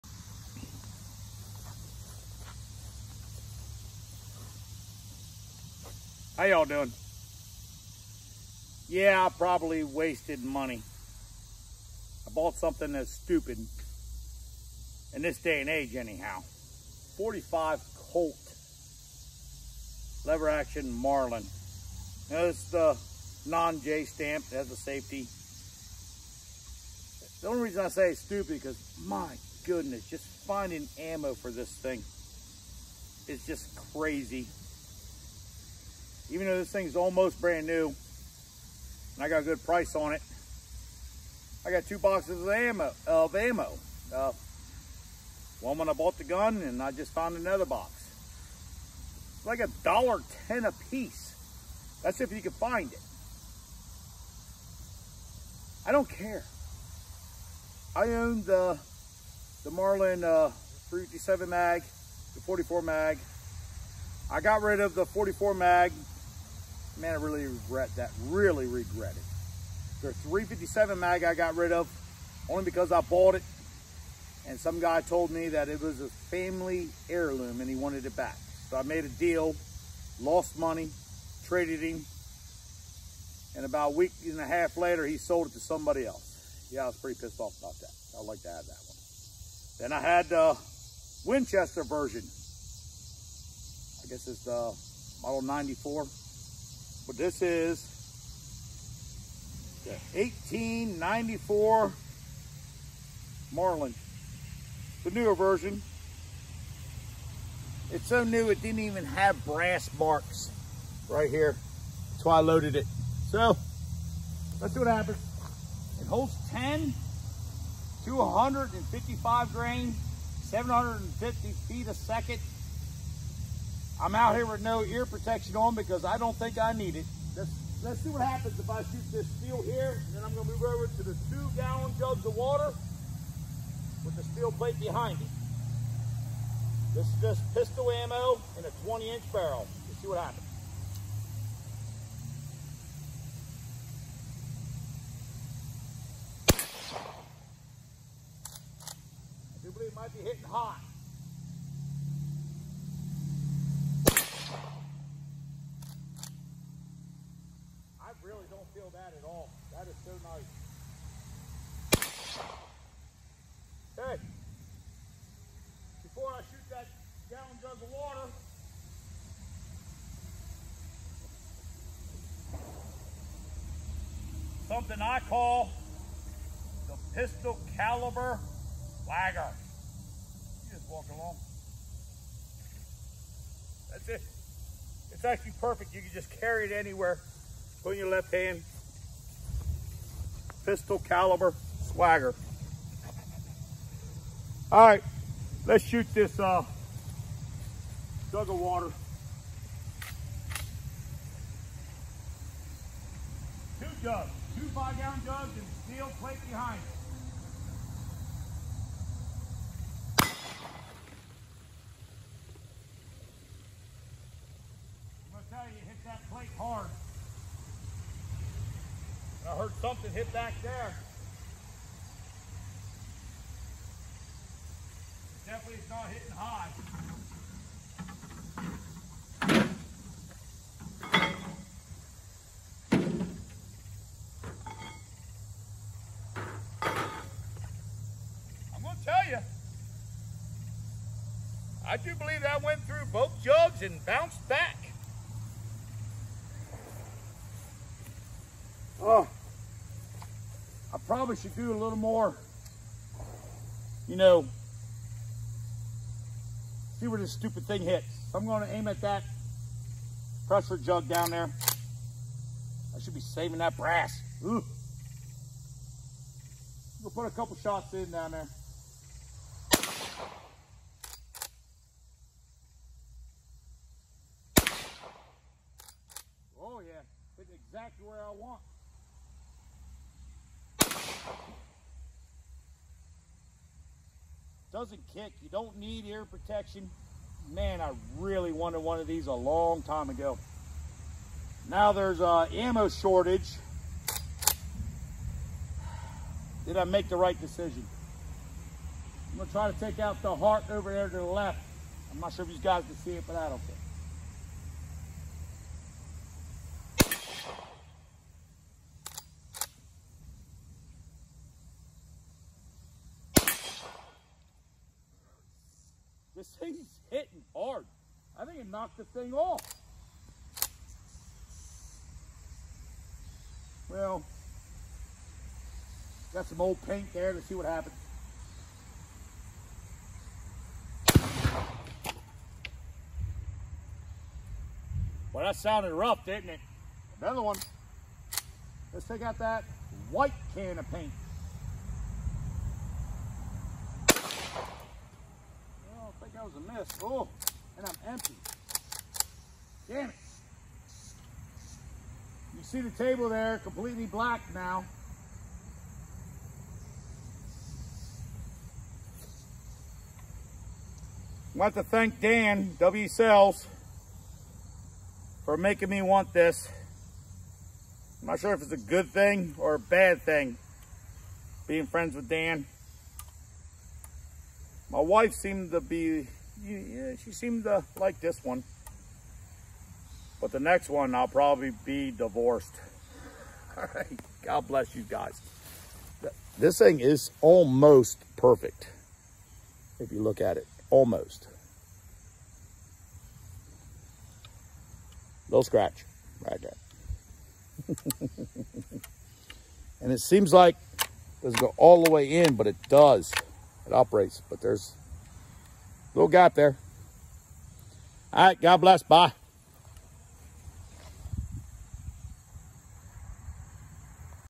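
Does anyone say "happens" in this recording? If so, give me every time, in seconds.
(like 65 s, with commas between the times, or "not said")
114 s, 128 s, 140 s, 327 s.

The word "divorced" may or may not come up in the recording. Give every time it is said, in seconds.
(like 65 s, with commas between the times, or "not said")
382 s.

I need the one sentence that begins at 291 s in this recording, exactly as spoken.
Now there's a uh, ammo shortage.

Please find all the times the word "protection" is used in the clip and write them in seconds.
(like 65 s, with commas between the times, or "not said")
125 s, 286 s.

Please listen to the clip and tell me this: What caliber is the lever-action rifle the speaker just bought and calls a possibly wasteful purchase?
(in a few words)
45 Colt.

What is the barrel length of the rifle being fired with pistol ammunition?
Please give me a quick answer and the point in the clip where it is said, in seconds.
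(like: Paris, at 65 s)
20 inches, at 138 s.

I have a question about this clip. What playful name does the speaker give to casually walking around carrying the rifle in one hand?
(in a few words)
pistol caliber swagger.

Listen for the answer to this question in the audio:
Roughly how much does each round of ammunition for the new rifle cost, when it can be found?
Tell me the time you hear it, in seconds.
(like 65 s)
49 s.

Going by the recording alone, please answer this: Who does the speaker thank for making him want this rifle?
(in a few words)
Dan W Sales.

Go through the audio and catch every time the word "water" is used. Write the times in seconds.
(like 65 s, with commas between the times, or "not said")
132 s, 167 s, 198 s.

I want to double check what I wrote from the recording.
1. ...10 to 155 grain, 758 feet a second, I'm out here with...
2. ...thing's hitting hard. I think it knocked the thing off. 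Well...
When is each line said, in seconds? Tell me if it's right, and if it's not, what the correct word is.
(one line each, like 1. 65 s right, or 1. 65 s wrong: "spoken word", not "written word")
1. 116 s wrong: "750", not "758"
2. 316 s right.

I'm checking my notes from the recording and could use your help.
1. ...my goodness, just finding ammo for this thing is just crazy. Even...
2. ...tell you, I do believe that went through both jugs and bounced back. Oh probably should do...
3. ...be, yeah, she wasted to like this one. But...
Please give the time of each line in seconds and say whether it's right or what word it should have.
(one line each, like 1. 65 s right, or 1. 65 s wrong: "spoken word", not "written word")
1. 29 s right
2. 239 s right
3. 375 s wrong: "seemed", not "wasted".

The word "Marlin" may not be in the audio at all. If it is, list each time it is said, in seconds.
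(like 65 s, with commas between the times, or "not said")
20 s, 59 s, 103 s.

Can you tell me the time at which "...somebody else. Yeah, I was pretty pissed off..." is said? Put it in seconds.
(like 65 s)
85 s.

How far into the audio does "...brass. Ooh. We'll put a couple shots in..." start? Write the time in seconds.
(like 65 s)
263 s.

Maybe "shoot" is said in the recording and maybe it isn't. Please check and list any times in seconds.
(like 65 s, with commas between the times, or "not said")
128 s, 166 s, 195 s.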